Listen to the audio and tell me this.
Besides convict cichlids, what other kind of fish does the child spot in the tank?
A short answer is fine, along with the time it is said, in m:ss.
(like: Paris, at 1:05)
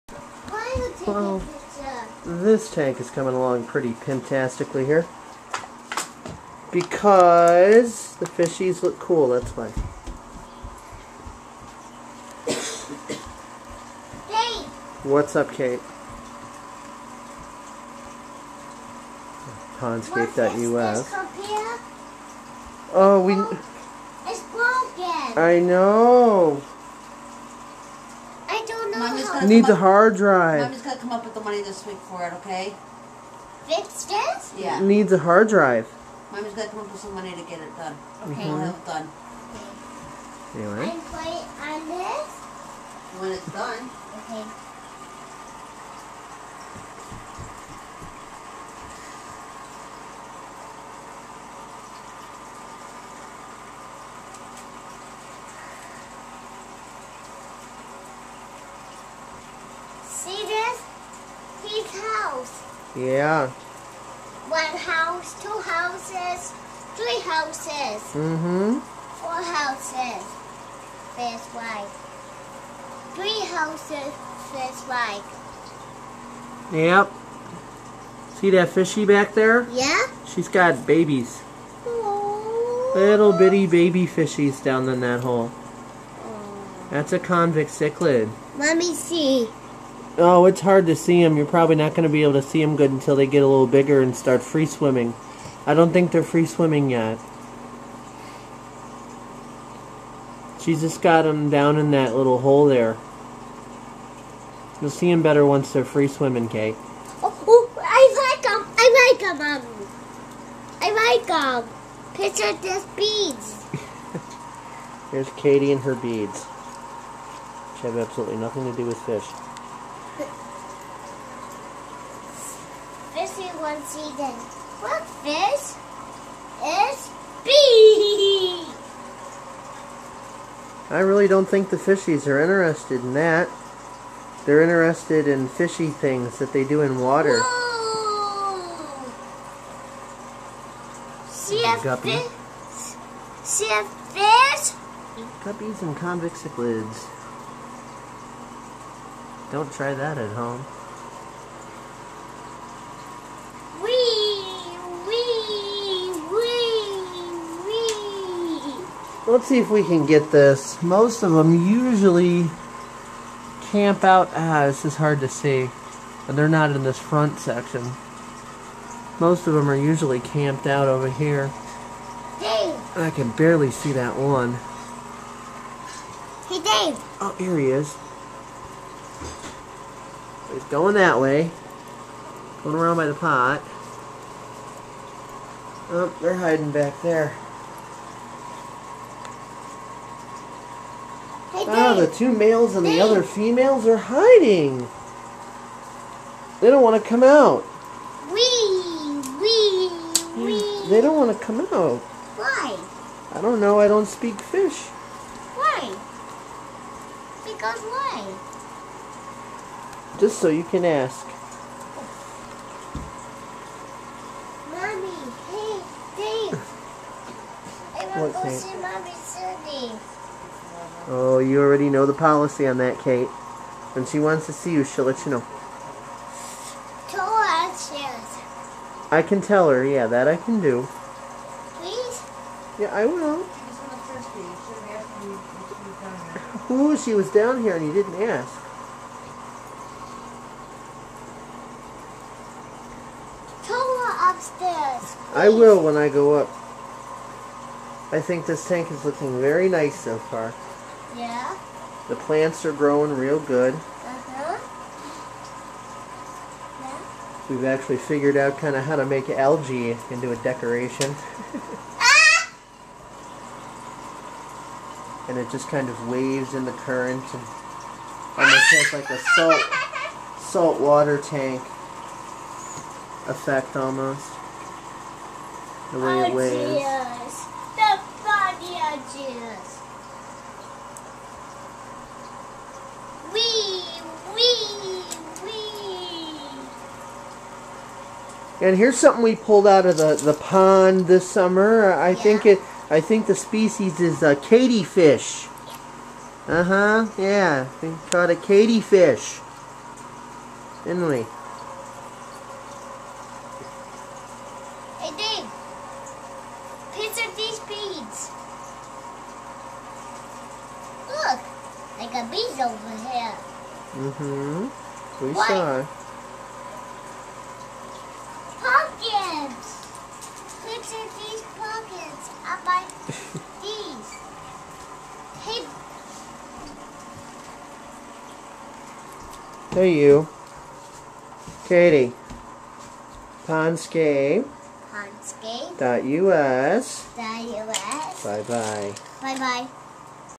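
Guppy, at 2:21.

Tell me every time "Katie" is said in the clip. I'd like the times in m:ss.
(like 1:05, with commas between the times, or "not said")
1:55, 5:31.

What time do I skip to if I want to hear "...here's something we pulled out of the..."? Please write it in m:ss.
4:48.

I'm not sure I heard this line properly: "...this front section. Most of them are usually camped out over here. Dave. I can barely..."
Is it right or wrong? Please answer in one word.
right.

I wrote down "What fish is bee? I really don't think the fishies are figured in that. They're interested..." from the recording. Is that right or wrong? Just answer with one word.
wrong.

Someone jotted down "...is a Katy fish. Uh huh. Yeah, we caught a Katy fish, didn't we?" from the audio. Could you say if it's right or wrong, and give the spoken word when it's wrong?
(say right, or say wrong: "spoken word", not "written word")
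right.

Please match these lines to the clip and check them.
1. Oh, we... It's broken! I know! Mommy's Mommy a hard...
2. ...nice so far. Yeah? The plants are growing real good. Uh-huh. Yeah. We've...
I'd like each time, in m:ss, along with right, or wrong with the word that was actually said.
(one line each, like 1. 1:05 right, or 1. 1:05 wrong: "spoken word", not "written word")
1. 0:22 wrong: "Needs", not "Mommy"
2. 4:09 right.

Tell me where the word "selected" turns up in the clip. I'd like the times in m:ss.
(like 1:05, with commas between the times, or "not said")
not said.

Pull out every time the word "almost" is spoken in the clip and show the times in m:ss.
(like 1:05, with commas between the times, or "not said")
4:28, 4:33.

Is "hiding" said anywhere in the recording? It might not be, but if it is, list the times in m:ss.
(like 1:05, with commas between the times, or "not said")
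3:06, 3:13.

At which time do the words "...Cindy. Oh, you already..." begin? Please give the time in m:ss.
3:39.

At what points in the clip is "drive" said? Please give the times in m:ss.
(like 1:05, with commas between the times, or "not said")
0:30, 0:35.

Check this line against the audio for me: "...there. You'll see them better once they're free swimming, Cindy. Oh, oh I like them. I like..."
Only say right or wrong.
wrong.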